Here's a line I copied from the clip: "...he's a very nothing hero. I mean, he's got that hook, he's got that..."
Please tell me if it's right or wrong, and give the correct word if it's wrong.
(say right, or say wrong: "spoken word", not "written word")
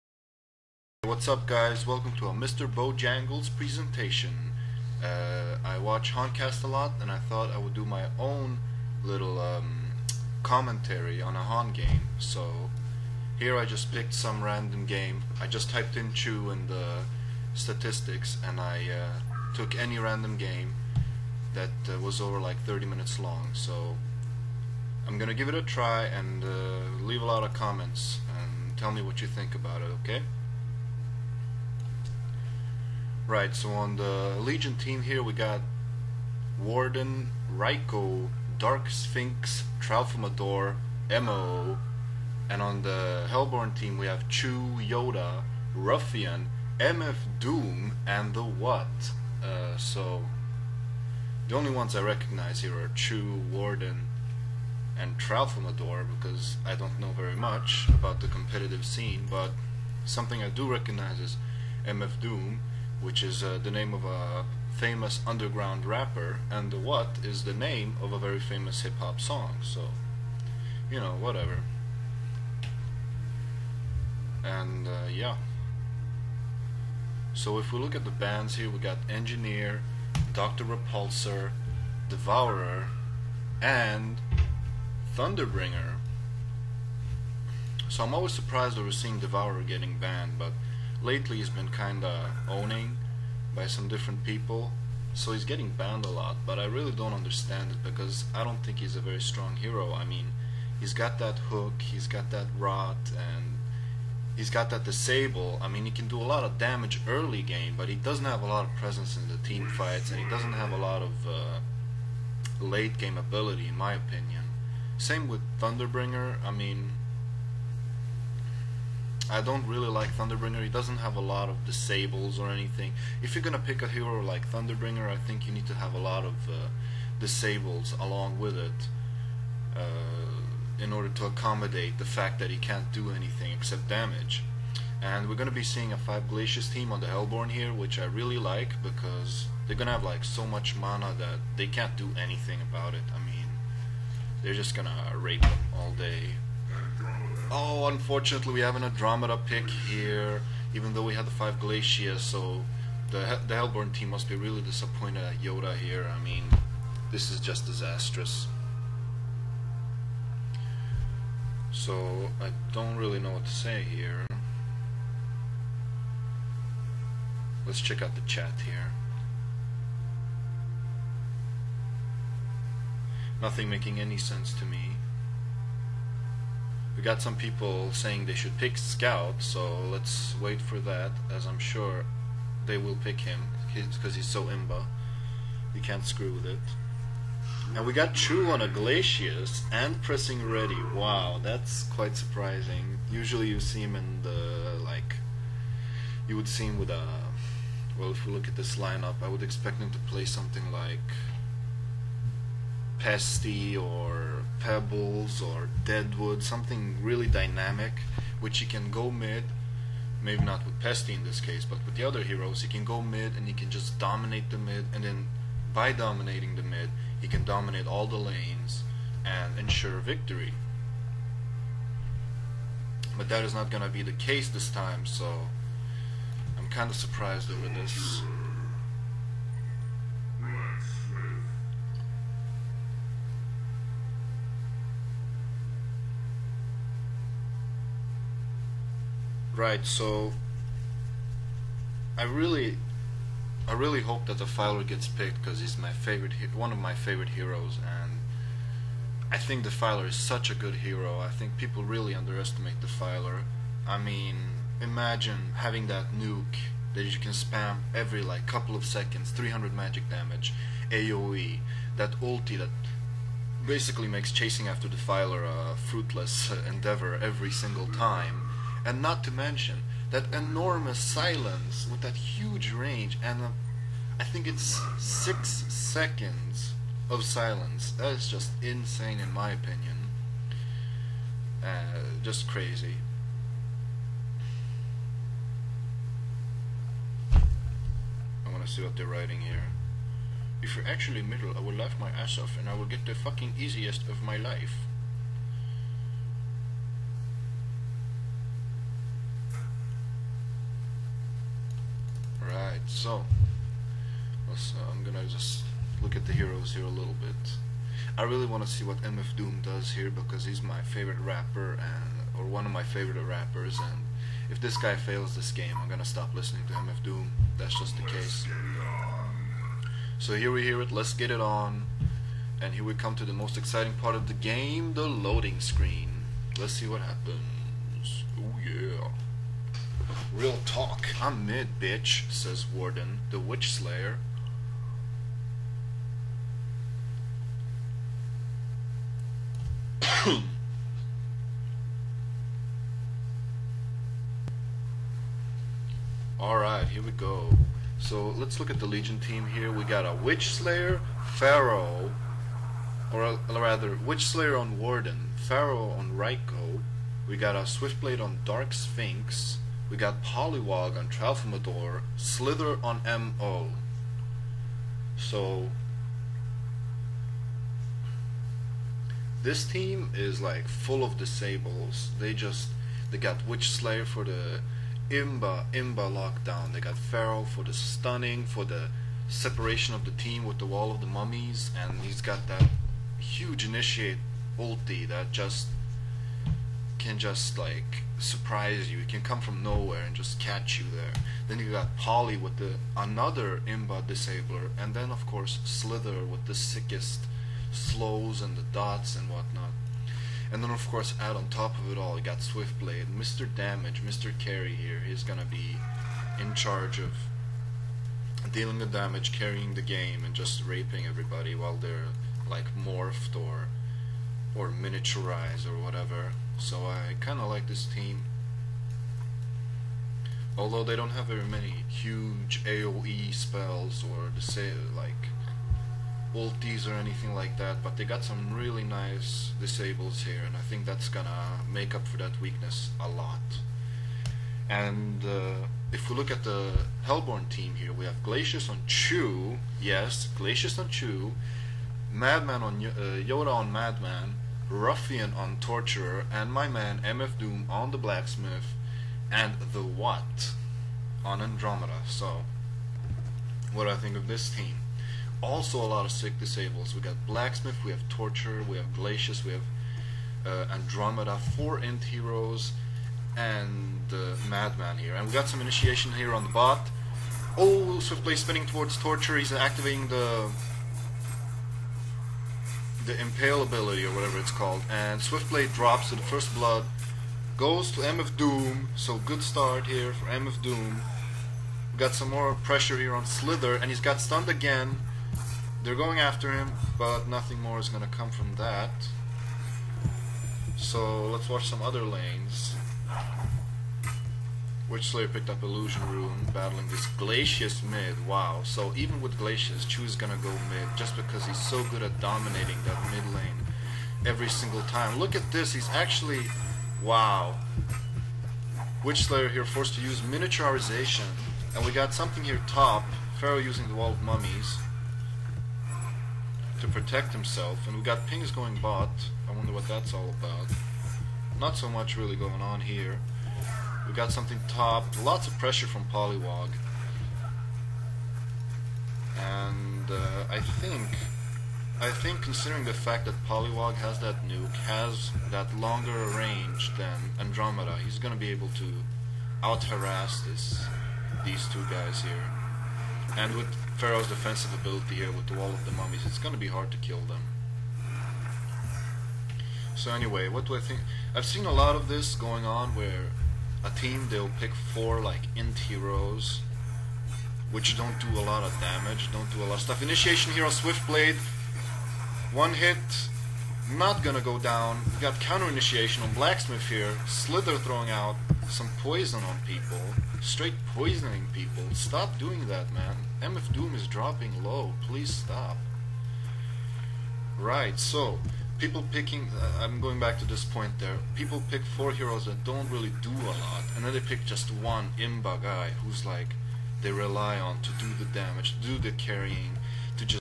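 wrong: "strong", not "nothing".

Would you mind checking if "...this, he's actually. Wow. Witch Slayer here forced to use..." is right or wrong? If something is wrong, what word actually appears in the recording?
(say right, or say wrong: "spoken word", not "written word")
right.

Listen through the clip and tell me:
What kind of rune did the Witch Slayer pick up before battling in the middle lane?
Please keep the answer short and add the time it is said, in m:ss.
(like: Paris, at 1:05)
Illusion Rune, at 8:15.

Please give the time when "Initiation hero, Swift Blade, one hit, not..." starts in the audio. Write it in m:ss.
9:20.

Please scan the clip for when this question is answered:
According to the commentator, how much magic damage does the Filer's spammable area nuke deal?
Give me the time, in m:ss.
4:19.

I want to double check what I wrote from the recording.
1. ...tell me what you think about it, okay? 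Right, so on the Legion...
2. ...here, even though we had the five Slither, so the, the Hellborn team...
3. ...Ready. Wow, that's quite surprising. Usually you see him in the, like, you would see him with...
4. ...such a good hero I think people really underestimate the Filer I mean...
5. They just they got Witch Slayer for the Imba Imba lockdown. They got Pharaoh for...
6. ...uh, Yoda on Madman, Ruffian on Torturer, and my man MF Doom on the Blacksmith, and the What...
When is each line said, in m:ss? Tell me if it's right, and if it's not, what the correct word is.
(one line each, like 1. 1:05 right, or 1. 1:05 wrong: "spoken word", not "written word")
1. 0:28 right
2. 2:29 wrong: "Glacius", not "Slither"
3. 3:10 right
4. 4:10 right
5. 6:12 right
6. 7:22 right.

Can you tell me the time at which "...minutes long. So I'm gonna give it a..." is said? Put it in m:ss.
0:22.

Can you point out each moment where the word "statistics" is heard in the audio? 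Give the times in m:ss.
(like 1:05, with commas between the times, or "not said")
0:17.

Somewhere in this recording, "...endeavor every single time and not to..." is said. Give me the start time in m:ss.
4:26.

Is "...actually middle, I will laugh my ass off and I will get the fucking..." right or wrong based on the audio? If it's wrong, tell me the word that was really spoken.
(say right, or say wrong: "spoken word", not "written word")
right.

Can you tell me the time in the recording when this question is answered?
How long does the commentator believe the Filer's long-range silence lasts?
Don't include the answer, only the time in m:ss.
4:34.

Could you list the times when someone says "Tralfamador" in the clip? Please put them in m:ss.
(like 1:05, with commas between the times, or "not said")
0:39, 0:55, 6:01.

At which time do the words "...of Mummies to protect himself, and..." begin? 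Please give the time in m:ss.
8:34.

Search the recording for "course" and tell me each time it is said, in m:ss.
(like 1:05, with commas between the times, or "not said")
6:35, 6:40.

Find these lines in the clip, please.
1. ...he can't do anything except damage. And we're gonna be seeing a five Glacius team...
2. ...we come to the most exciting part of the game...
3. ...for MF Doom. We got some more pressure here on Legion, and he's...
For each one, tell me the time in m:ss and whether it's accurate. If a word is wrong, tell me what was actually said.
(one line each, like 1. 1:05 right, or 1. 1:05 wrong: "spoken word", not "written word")
1. 2:12 right
2. 5:22 right
3. 8:00 wrong: "Slither", not "Legion".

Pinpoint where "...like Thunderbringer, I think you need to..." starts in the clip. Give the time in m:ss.
2:04.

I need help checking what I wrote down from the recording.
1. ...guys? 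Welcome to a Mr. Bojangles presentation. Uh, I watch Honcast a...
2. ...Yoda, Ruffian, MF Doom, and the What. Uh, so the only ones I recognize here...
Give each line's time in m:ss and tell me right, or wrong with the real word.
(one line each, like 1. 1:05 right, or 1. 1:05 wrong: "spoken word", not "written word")
1. 0:01 right
2. 0:44 right.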